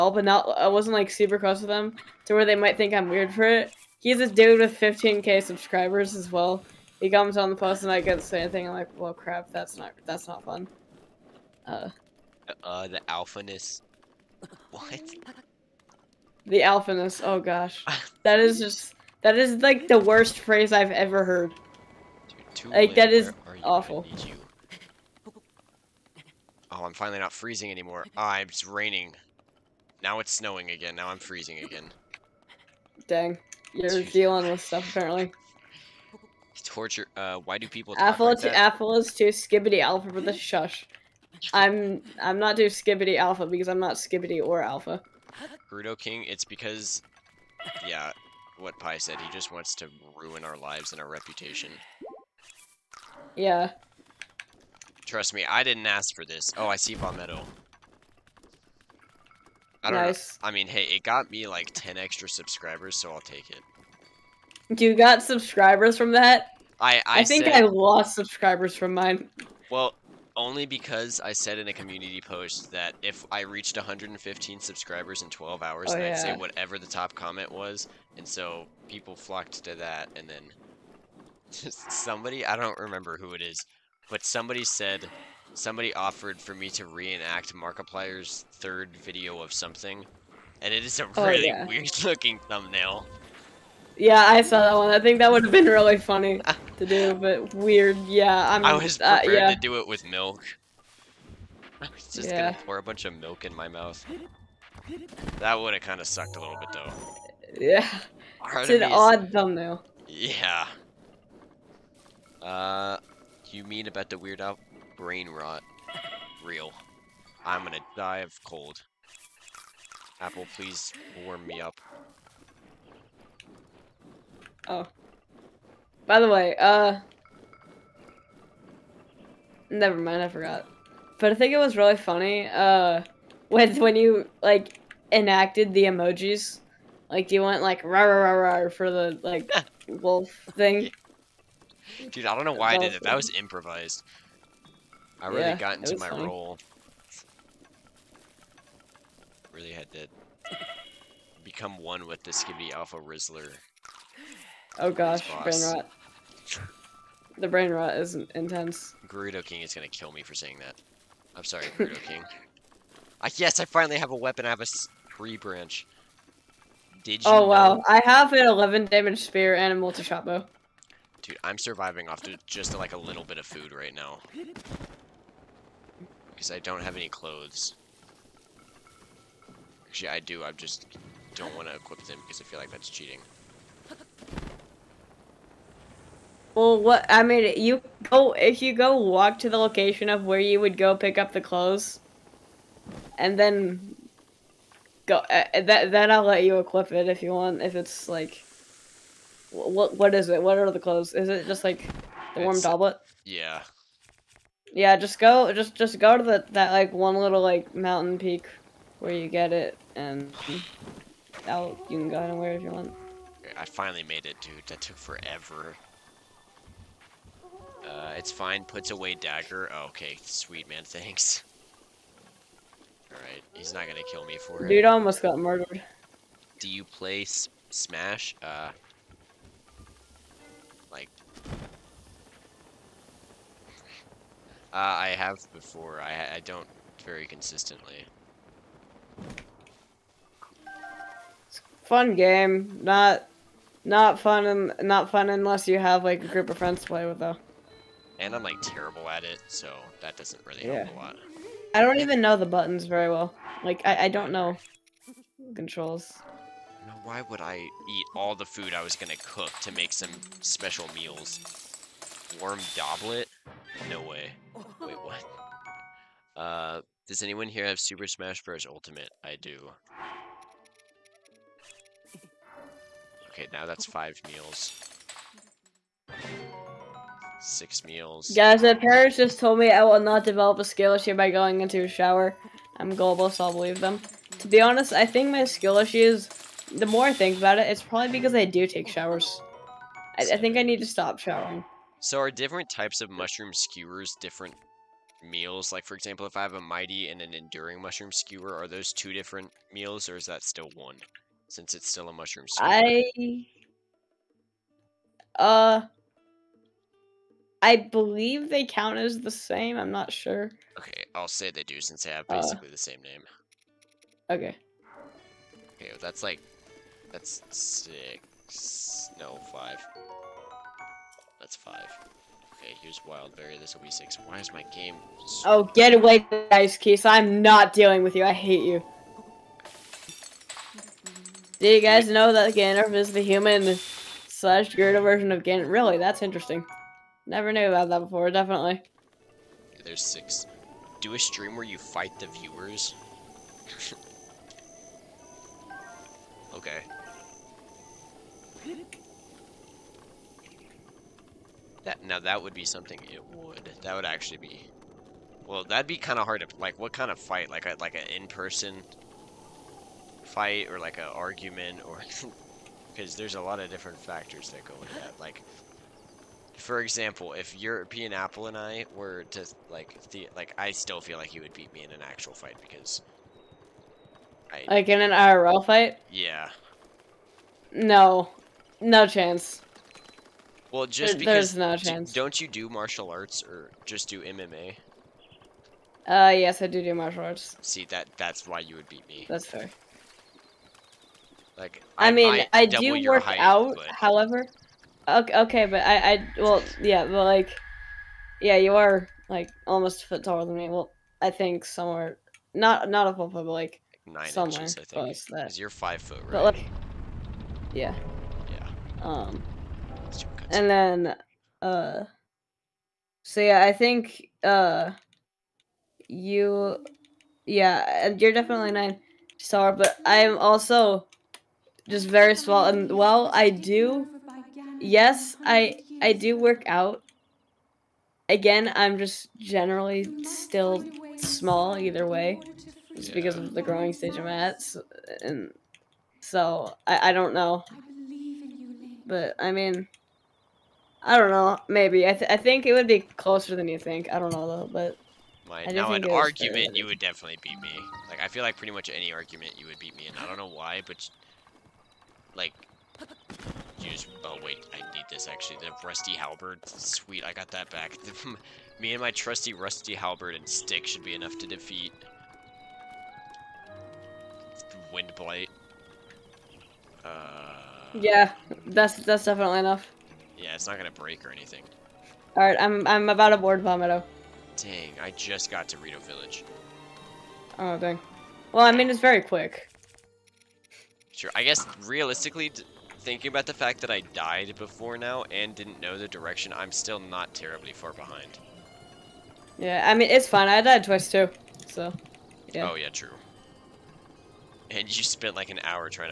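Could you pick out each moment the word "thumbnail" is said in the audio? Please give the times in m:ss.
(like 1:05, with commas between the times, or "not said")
1:32, 1:49.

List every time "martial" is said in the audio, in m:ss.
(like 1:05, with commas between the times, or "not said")
6:22, 6:26.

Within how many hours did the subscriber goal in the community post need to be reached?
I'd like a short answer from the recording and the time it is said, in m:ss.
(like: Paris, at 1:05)
12, at 1:15.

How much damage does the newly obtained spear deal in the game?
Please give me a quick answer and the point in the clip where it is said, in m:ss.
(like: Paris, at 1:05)
11, at 2:48.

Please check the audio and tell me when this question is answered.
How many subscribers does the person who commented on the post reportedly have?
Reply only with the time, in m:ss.
0:04.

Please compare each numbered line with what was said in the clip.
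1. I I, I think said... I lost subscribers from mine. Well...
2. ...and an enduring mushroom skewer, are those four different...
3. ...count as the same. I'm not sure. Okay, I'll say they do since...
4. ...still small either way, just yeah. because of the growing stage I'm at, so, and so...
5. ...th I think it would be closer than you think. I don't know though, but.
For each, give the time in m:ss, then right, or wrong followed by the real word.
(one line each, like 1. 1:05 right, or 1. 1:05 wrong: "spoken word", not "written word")
1. 1:06 right
2. 4:57 wrong: "two", not "four"
3. 5:08 right
4. 7:10 right
5. 7:22 right.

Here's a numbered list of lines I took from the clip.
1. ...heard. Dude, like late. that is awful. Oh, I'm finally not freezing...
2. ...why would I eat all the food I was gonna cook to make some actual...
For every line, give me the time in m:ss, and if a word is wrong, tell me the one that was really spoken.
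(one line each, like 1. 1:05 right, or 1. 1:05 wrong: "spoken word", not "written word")
1. 0:21 right
2. 4:17 wrong: "special", not "actual".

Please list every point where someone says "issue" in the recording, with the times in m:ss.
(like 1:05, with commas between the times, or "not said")
4:40, 4:45.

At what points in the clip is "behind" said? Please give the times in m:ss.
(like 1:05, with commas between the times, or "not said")
8:07.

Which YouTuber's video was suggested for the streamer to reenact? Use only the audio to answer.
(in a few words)
Markiplier.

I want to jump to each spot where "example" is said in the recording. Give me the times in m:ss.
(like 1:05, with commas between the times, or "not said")
4:55, 6:06.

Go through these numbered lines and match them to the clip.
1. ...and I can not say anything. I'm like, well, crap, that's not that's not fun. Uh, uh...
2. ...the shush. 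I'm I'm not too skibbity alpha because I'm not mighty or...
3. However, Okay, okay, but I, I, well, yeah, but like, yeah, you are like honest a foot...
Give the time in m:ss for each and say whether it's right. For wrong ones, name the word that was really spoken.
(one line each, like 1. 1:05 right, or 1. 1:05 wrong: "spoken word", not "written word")
1. 0:07 right
2. 0:40 wrong: "skibbity", not "mighty"
3. 6:33 wrong: "almost", not "honest".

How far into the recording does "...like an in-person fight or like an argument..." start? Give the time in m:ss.
5:57.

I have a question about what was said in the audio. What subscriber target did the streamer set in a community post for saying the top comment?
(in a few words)
115.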